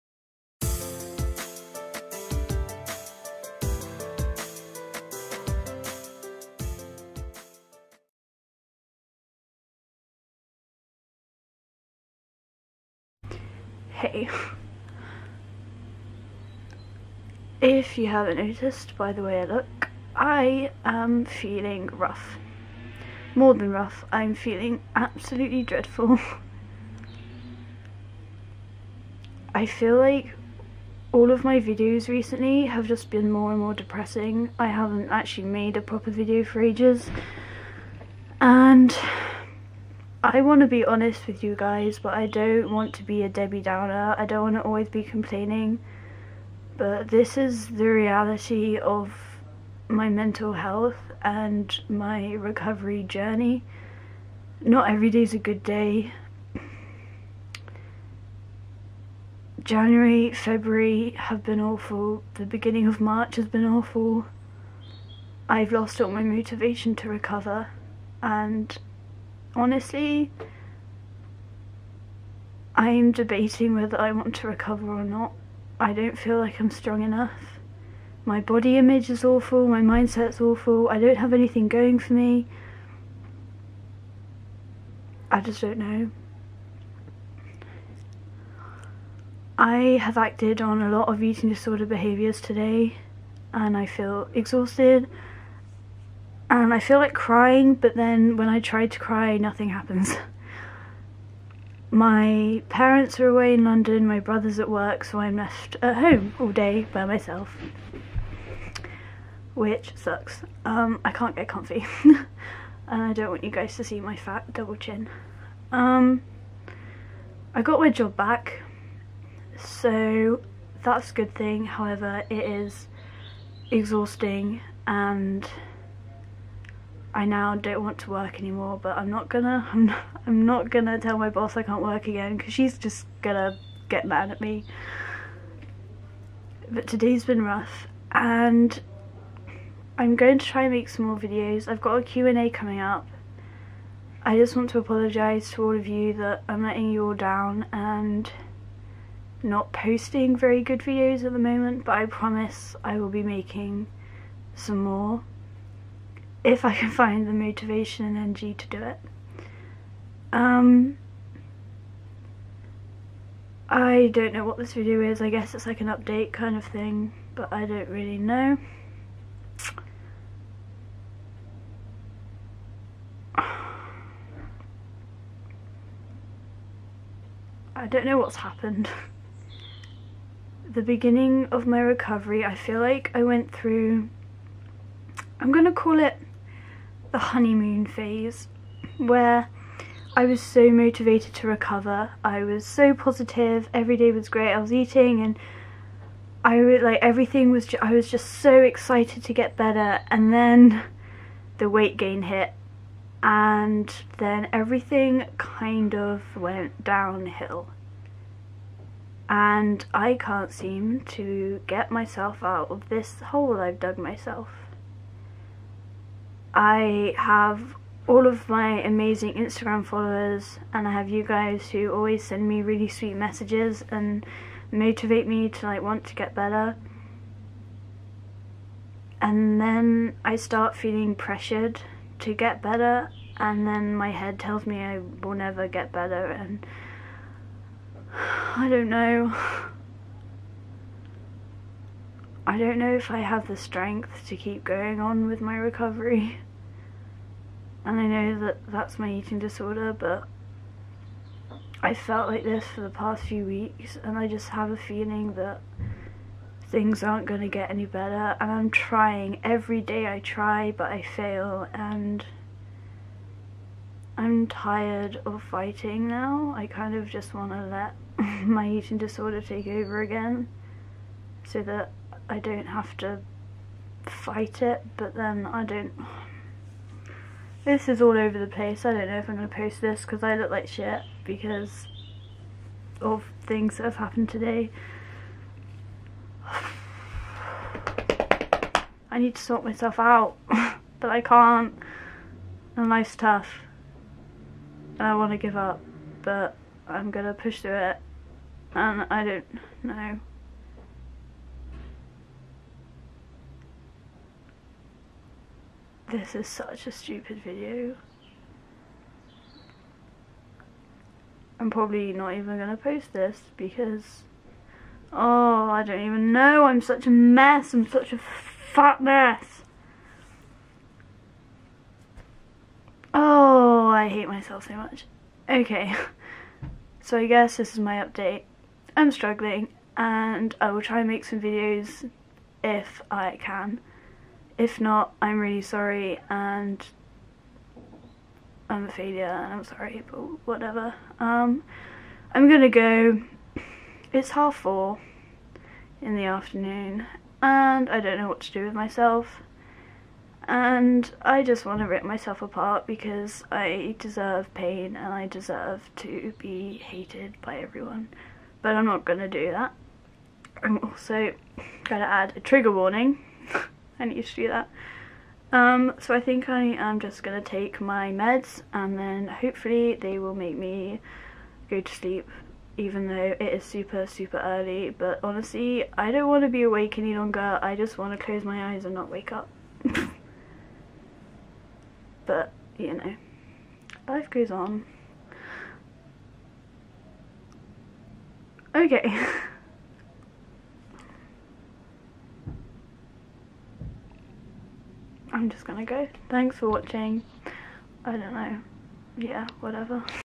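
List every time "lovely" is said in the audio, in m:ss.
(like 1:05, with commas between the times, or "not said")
not said.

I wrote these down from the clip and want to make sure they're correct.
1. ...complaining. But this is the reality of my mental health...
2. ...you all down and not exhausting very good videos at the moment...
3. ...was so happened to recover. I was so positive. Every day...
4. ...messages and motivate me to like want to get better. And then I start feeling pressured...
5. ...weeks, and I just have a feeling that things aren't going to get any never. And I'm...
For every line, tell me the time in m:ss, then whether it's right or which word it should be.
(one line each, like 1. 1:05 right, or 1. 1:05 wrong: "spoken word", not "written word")
1. 0:45 right
2. 2:26 wrong: "posting", not "exhausting"
3. 3:10 wrong: "motivated", not "happened"
4. 3:43 right
5. 4:13 wrong: "better", not "never".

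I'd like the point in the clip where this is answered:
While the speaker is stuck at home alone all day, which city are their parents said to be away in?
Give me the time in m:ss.
1:43.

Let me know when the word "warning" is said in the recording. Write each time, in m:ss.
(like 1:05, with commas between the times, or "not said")
6:02.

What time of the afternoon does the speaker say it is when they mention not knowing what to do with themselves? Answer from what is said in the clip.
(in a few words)
half four.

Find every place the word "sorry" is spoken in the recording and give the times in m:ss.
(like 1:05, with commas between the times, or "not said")
5:35, 5:39.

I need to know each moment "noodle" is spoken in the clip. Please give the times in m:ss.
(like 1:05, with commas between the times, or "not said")
not said.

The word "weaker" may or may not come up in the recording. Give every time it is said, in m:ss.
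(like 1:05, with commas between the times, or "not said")
not said.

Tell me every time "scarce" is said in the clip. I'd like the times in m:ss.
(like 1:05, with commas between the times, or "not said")
not said.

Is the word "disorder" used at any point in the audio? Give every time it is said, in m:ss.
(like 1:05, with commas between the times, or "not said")
1:31, 4:09, 4:28.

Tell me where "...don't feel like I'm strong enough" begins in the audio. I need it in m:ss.
1:15.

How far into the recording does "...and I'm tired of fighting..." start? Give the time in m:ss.
4:21.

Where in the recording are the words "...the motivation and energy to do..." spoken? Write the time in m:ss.
2:37.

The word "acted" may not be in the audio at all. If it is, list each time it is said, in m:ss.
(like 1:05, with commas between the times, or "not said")
1:30.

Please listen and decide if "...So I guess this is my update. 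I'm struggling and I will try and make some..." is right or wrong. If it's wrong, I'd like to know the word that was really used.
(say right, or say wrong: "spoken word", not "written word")
right.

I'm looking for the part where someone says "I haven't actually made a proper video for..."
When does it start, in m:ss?
0:34.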